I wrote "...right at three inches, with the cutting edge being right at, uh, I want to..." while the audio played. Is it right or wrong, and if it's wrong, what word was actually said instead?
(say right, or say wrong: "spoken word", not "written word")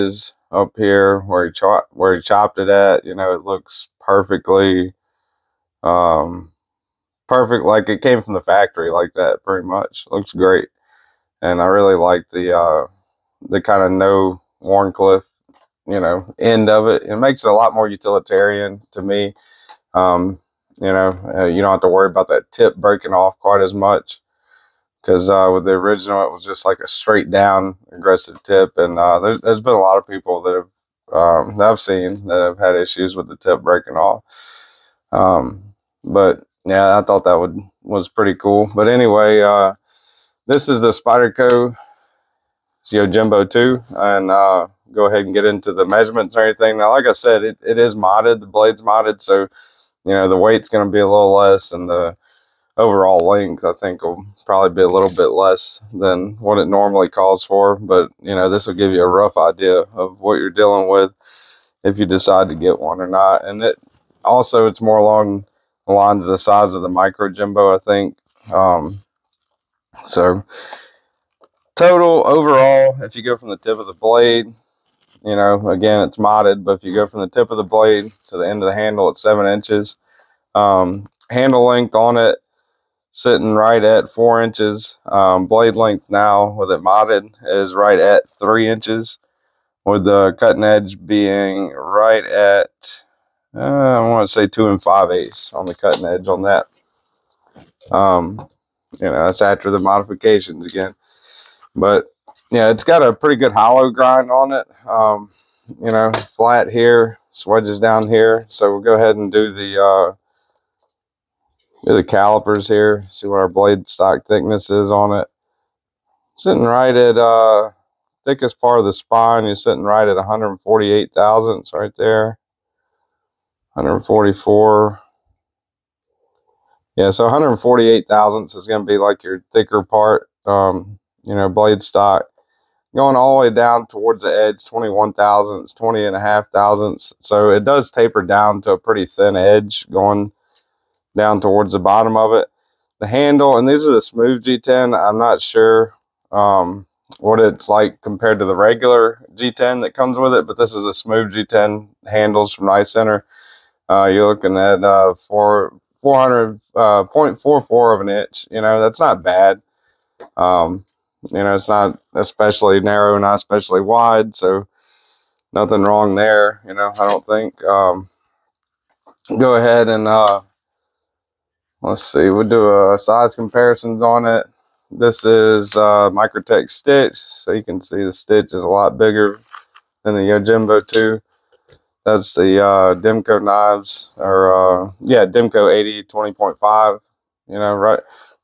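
right.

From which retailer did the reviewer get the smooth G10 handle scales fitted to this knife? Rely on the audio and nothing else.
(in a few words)
Knife Center.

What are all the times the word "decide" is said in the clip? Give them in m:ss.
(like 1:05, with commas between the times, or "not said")
1:02.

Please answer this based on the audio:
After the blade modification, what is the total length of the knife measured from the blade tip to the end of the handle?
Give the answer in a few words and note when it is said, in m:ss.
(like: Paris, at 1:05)
7 inches, at 1:19.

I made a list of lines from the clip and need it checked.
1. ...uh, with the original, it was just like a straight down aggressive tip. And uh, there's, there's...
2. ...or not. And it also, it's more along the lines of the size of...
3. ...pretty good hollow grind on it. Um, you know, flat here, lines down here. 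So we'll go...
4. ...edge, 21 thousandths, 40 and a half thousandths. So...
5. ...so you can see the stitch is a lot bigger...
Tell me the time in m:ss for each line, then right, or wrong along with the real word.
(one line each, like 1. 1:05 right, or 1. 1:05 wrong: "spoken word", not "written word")
1. 0:25 right
2. 1:03 right
3. 1:43 wrong: "swedges", not "lines"
4. 2:14 wrong: "20", not "40"
5. 2:57 right.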